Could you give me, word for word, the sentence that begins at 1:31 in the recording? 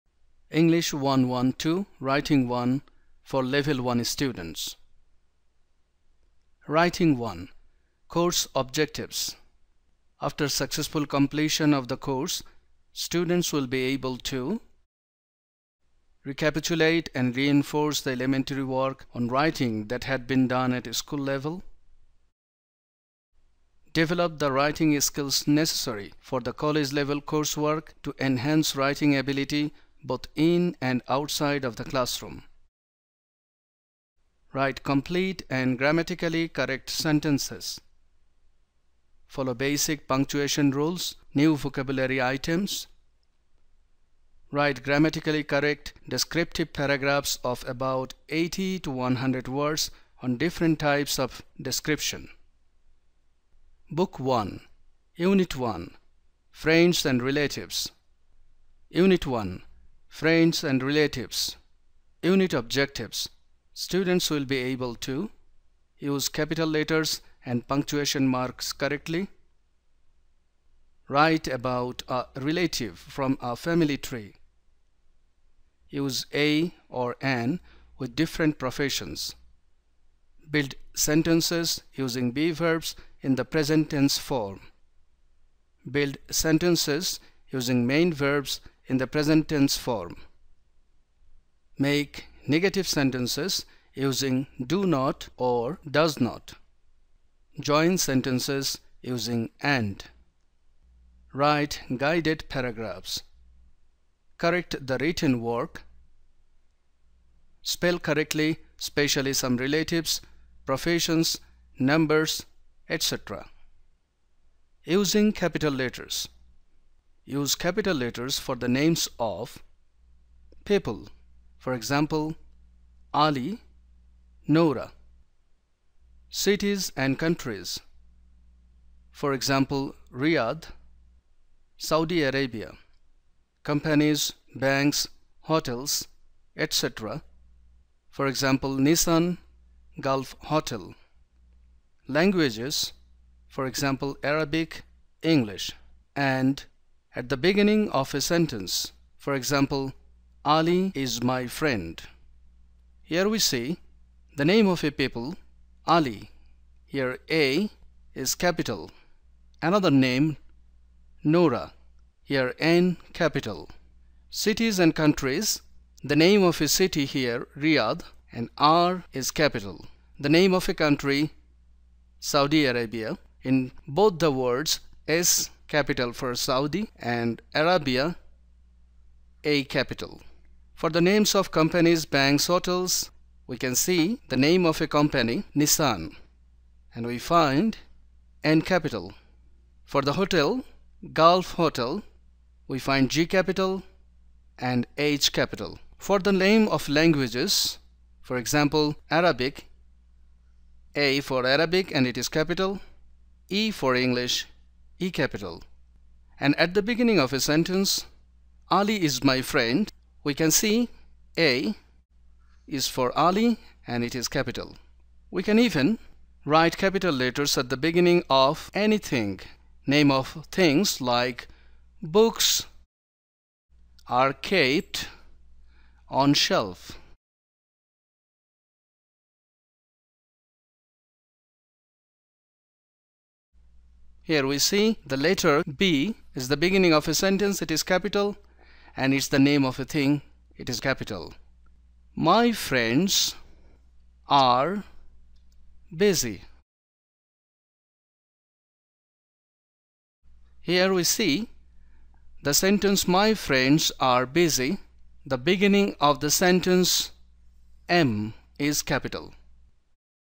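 Make negative sentences using do not or does not.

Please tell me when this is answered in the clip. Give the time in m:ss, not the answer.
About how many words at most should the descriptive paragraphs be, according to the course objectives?
0:48.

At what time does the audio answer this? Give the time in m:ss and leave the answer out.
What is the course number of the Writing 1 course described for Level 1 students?
0:00.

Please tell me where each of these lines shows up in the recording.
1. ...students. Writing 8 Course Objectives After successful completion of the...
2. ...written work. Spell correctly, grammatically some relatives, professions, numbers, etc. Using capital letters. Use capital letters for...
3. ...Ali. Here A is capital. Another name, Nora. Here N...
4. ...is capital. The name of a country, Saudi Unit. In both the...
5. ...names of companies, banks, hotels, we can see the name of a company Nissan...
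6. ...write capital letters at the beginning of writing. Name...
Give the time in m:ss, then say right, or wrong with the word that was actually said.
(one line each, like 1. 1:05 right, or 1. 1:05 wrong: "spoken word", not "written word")
1. 0:04 wrong: "1", not "8"
2. 1:44 wrong: "especially", not "grammatically"
3. 2:35 right
4. 2:49 wrong: "Arabia", not "Unit"
5. 3:01 right
6. 3:36 wrong: "anything", not "writing".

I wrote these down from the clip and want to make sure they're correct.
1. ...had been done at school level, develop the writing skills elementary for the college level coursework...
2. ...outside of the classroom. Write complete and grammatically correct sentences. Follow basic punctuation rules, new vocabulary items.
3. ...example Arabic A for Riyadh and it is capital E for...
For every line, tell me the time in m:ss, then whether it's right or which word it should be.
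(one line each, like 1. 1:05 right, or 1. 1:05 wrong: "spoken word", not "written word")
1. 0:20 wrong: "necessary", not "elementary"
2. 0:31 right
3. 3:18 wrong: "Arabic", not "Riyadh".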